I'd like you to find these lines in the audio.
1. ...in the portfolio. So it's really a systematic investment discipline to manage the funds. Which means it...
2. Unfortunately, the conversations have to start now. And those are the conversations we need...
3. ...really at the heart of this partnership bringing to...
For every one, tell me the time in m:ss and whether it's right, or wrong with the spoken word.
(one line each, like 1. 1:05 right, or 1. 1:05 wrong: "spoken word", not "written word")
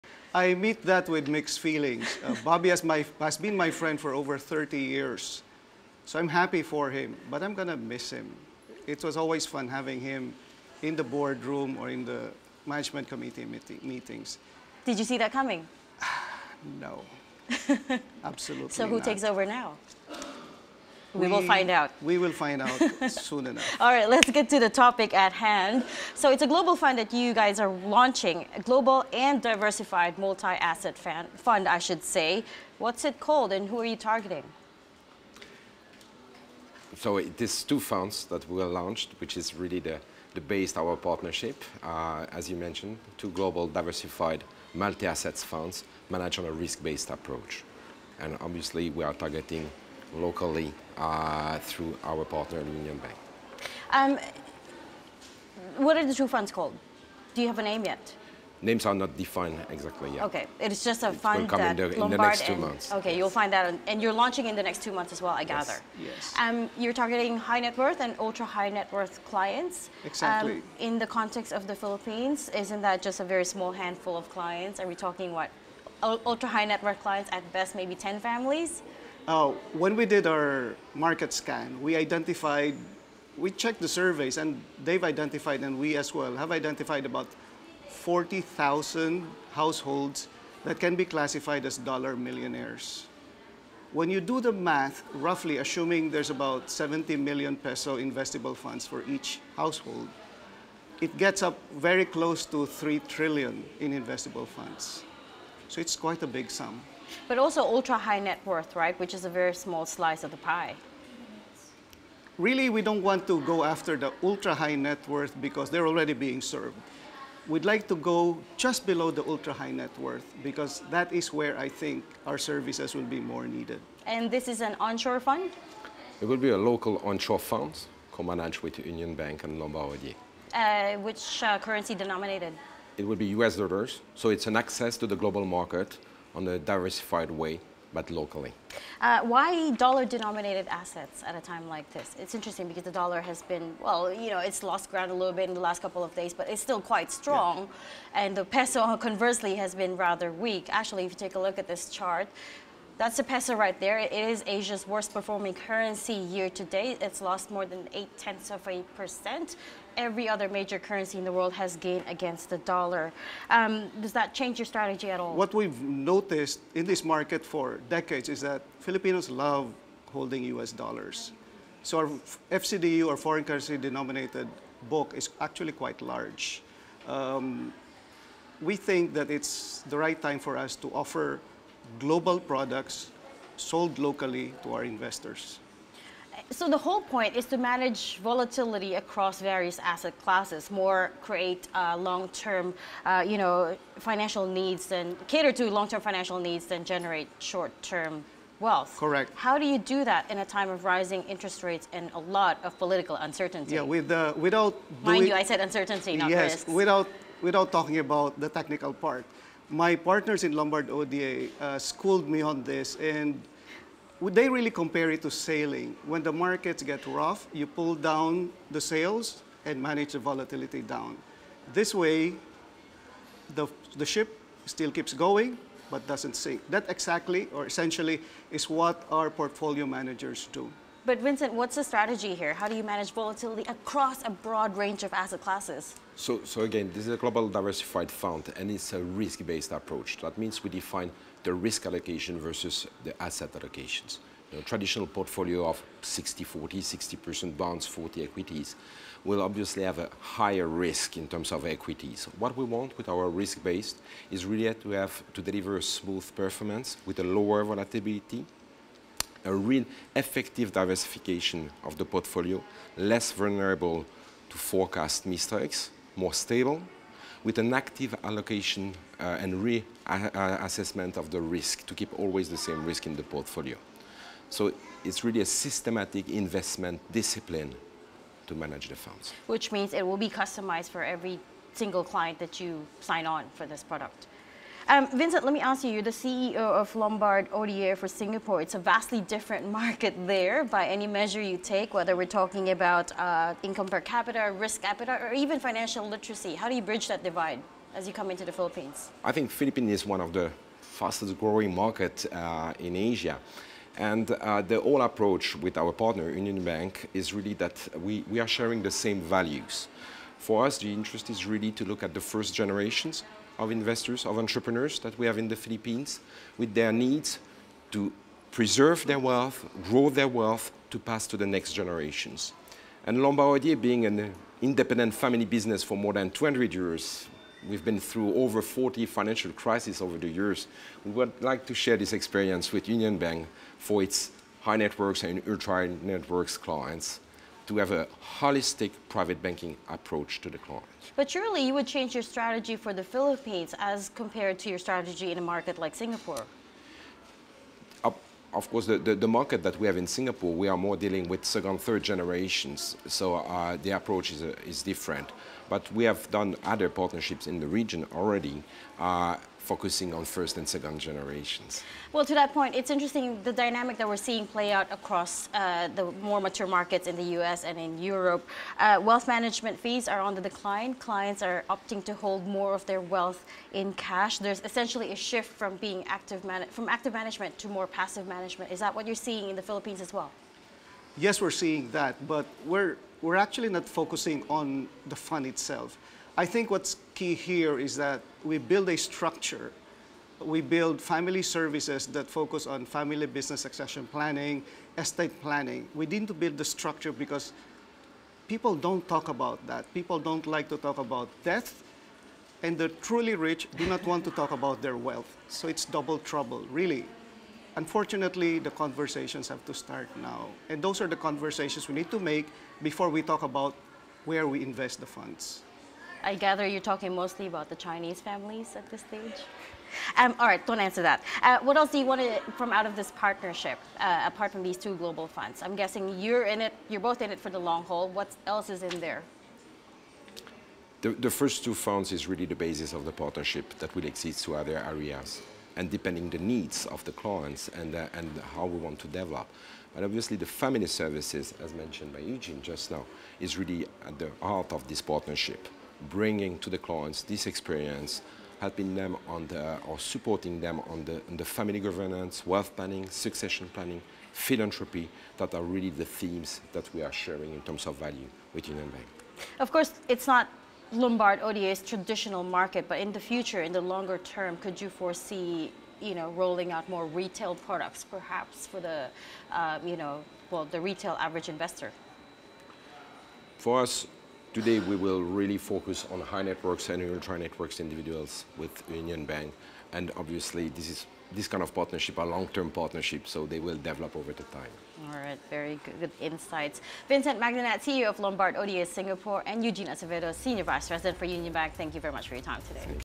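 1. 4:33 right
2. 6:47 right
3. 7:23 right.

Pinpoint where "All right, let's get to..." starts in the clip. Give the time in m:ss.
0:23.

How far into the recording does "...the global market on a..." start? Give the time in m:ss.
2:15.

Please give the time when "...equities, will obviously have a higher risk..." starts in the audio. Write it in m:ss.
4:08.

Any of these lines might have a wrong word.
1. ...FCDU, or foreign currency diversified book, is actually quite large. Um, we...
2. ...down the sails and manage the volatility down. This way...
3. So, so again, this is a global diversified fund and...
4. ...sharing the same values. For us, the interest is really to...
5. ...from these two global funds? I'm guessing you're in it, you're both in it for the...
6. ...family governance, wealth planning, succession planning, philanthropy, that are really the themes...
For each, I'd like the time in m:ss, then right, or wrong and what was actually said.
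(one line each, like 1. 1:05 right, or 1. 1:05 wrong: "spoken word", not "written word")
1. 2:52 wrong: "denominated", not "diversified"
2. 3:37 right
3. 3:56 right
4. 5:08 right
5. 7:04 right
6. 7:31 right.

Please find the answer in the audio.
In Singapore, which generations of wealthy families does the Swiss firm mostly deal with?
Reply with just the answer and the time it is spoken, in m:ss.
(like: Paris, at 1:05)
second, third generations, at 5:51.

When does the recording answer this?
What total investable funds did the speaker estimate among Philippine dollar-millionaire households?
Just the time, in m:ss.
1:42.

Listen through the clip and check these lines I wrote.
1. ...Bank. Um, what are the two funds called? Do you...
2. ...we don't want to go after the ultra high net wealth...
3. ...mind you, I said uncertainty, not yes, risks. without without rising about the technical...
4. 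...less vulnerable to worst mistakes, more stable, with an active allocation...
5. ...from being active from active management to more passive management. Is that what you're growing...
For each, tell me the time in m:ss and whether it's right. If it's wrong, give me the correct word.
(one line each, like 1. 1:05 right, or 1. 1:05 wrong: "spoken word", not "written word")
1. 0:52 right
2. 1:52 wrong: "worth", not "wealth"
3. 3:25 wrong: "talking", not "rising"
4. 4:22 wrong: "forecast", not "worst"
5. 6:15 wrong: "seeing", not "growing".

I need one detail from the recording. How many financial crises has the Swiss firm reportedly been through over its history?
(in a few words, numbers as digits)
over 40.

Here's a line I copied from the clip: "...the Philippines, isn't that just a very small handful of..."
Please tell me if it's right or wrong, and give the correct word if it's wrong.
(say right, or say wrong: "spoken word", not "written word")
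right.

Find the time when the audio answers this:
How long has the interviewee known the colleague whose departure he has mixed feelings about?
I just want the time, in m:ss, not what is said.
0:04.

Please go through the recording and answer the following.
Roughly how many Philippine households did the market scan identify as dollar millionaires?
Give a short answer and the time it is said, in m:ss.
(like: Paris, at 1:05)
40,000, at 1:27.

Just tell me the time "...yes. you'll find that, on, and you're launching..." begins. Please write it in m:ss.
1:03.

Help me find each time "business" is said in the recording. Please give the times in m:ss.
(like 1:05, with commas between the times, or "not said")
5:25, 6:33.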